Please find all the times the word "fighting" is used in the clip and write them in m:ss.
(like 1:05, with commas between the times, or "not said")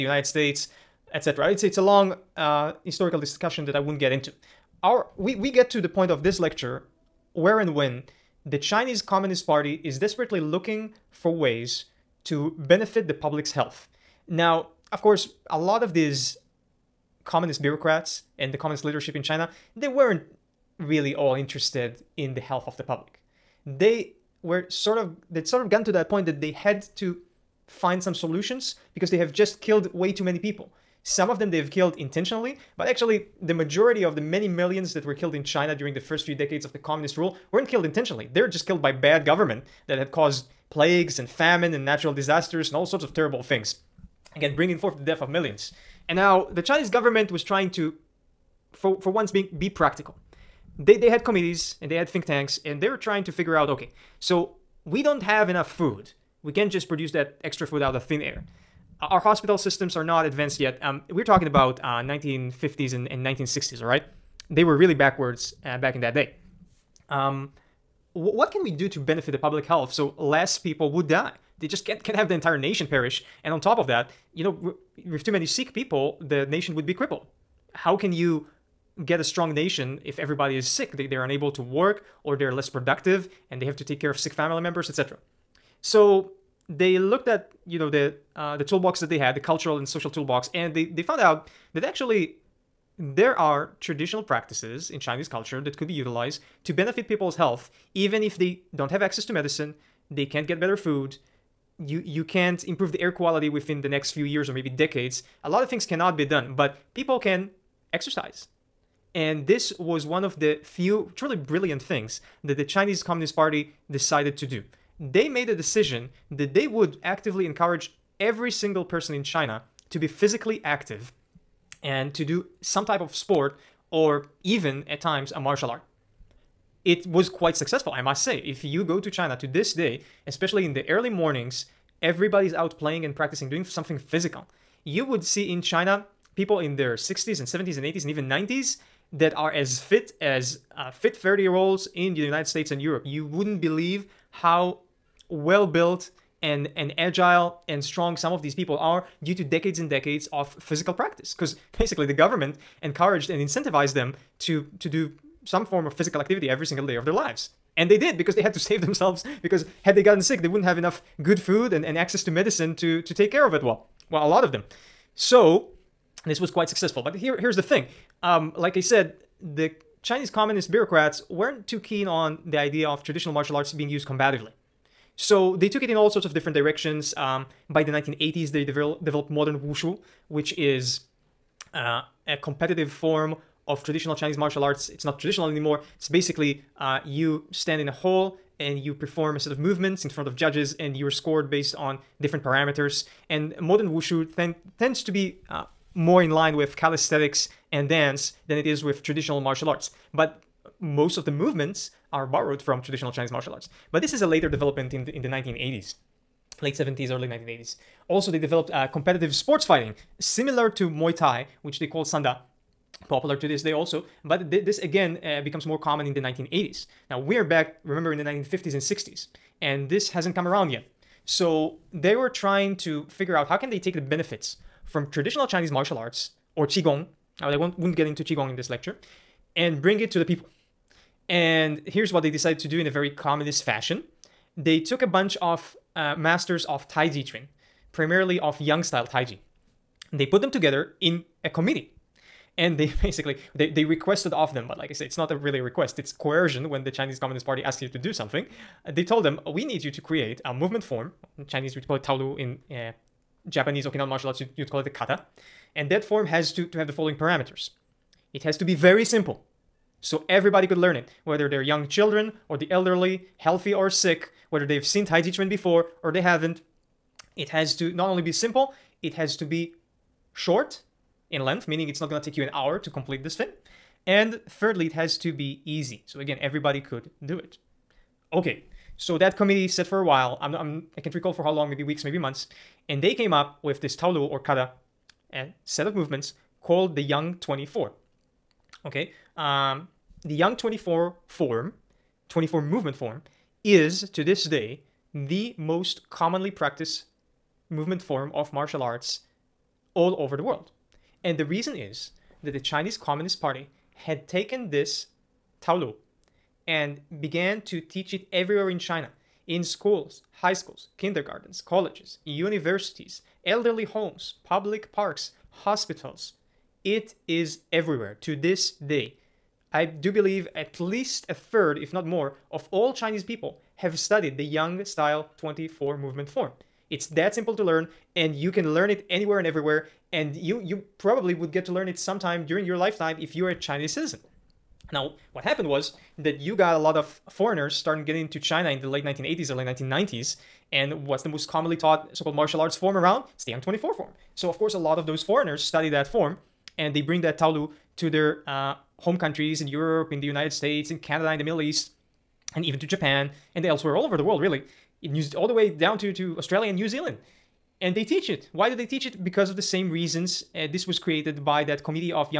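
3:29.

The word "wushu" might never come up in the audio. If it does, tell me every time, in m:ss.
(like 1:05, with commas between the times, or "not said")
2:59, 3:13.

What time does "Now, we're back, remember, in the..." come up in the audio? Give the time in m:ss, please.
3:37.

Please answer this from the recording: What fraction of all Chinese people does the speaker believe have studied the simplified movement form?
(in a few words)
a third.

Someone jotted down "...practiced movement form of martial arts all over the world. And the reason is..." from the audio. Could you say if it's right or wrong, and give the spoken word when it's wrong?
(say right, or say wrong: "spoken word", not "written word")
right.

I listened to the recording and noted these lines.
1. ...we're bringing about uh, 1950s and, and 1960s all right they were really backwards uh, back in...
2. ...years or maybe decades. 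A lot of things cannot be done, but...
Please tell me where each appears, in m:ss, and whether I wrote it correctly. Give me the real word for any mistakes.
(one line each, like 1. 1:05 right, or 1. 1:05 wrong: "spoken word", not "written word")
1. 1:01 wrong: "talking", not "bringing"
2. 1:44 right.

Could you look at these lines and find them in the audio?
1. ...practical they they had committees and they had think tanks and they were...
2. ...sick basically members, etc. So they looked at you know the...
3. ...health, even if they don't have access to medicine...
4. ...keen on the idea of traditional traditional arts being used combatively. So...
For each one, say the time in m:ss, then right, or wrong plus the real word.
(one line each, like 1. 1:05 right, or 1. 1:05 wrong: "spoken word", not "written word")
1. 0:49 right
2. 1:24 wrong: "family", not "basically"
3. 1:37 right
4. 2:51 wrong: "martial", not "traditional".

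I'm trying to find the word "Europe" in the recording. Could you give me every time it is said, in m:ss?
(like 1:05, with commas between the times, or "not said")
2:22, 5:49.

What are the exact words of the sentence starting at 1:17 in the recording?
How can you get a strong nation if everybody is sick?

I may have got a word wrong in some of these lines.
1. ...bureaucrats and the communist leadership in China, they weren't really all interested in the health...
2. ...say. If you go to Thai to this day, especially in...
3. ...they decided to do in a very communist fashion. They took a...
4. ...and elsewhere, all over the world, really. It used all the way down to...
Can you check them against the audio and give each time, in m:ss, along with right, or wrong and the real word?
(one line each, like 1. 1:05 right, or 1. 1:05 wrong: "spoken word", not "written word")
1. 0:17 right
2. 2:08 wrong: "China", not "Thai"
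3. 3:52 right
4. 5:53 right.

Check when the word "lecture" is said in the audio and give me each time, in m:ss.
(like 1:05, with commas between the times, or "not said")
0:06, 3:48.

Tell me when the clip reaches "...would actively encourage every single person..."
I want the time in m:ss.
1:56.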